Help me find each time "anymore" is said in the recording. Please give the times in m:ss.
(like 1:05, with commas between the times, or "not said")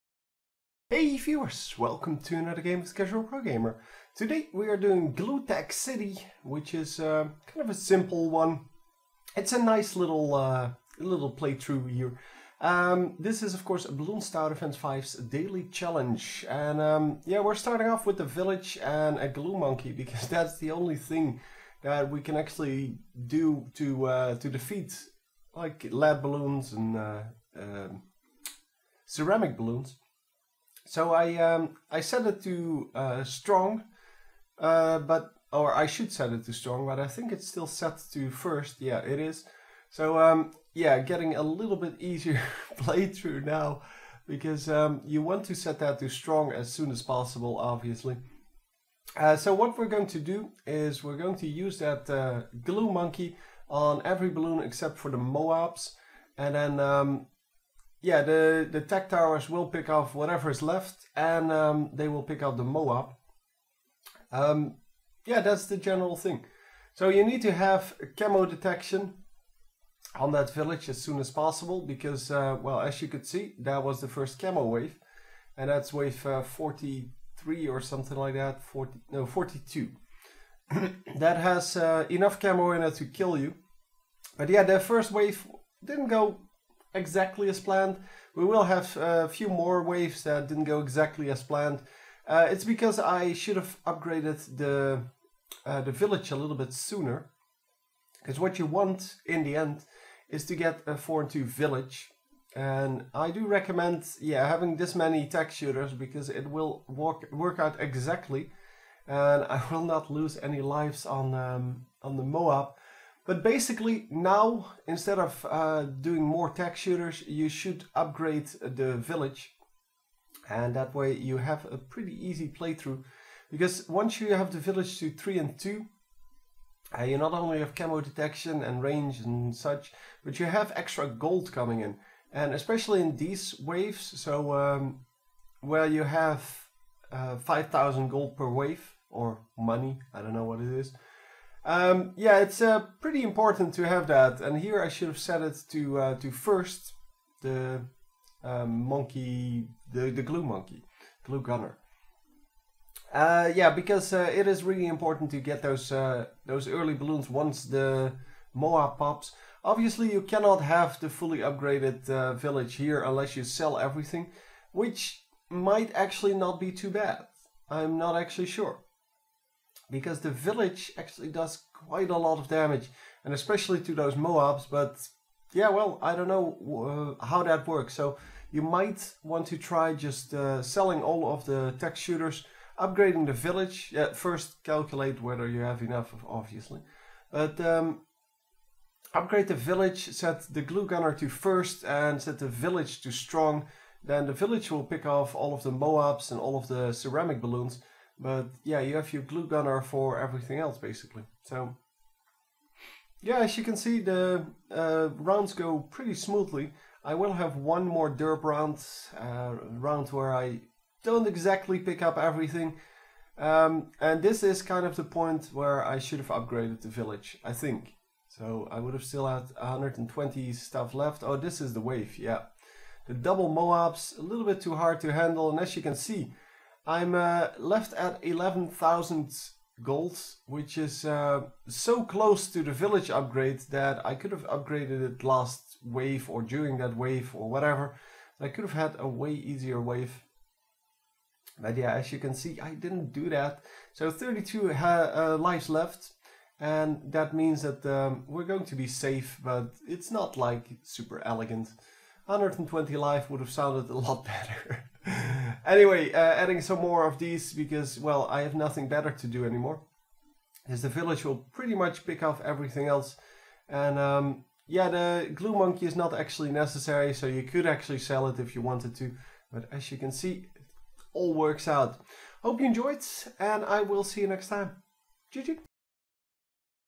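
4:19.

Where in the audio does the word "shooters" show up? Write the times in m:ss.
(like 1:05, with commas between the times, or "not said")
1:45, 1:56, 3:01.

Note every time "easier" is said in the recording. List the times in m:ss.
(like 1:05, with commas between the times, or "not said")
0:42, 3:59.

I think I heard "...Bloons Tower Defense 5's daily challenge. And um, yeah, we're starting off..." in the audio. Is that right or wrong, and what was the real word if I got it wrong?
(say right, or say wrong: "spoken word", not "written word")
right.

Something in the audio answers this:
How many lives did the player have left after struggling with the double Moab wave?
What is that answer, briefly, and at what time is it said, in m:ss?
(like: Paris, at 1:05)
32, at 4:04.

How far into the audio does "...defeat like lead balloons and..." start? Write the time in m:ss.
0:24.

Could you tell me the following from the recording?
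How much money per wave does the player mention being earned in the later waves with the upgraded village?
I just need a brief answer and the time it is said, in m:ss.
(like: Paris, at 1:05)
5,000, at 2:17.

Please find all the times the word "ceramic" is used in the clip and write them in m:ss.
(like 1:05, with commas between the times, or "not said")
0:29, 3:16.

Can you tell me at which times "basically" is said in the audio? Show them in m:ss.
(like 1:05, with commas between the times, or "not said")
1:53, 3:20.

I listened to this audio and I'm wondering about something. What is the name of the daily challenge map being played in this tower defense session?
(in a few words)
Glutech City.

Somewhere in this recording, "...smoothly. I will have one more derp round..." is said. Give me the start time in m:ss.
3:26.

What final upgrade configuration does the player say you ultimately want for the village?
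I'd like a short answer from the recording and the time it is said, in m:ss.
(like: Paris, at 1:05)
4 and 2, at 1:40.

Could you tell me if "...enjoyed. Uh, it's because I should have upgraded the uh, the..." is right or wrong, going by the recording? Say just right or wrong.
wrong.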